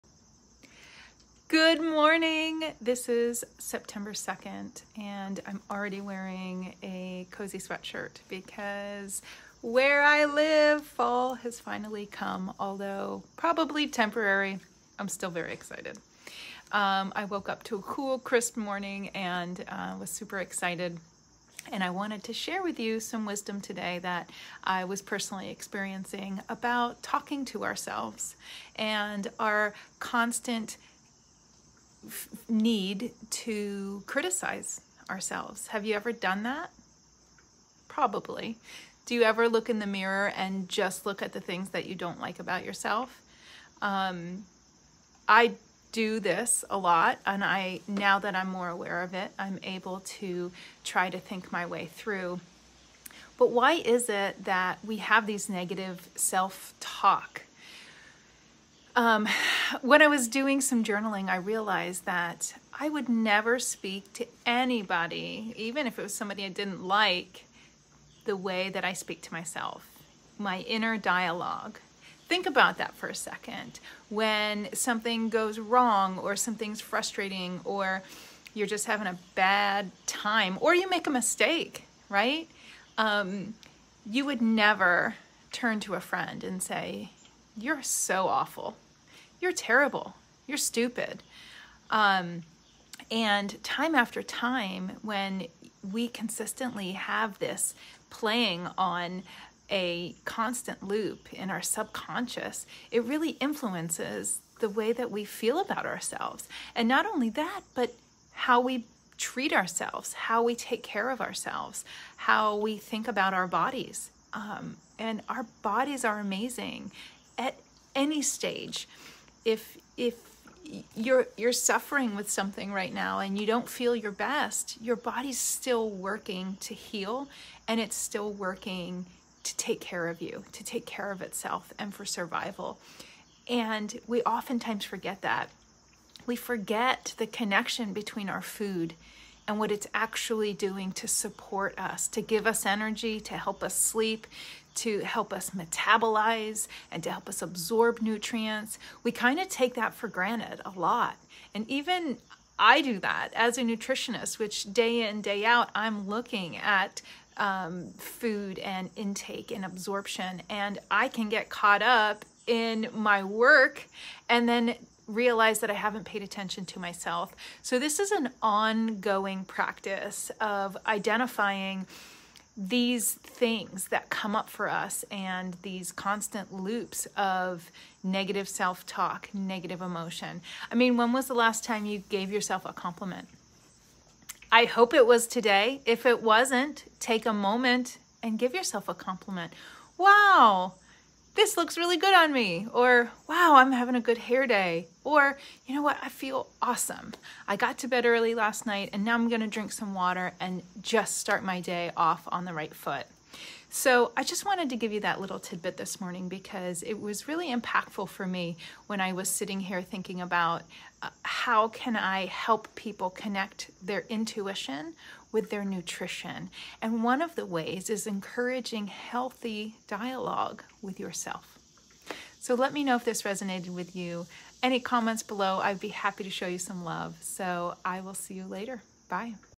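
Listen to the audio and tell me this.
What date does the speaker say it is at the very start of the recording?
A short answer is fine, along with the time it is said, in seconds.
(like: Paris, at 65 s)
September 2, at 3 s.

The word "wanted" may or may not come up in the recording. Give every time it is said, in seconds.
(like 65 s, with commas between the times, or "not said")
21 s, 204 s.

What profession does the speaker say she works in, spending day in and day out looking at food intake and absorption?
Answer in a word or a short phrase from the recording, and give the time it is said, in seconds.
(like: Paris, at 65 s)
Nutritionist, at 153 s.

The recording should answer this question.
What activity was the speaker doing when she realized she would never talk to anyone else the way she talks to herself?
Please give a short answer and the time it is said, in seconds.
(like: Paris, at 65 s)
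Journaling, at 60 s.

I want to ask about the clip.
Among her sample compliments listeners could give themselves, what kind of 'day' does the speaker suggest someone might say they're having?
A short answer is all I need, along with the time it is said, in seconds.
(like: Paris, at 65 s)
Good hair day, at 194 s.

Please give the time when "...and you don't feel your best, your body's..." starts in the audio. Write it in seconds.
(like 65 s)
123 s.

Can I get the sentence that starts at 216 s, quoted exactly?
And one of the ways is encouraging healthy dialogue with yourself.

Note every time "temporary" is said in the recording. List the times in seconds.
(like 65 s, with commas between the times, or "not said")
13 s.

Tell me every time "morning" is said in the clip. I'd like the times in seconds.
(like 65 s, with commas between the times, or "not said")
1 s, 18 s, 206 s.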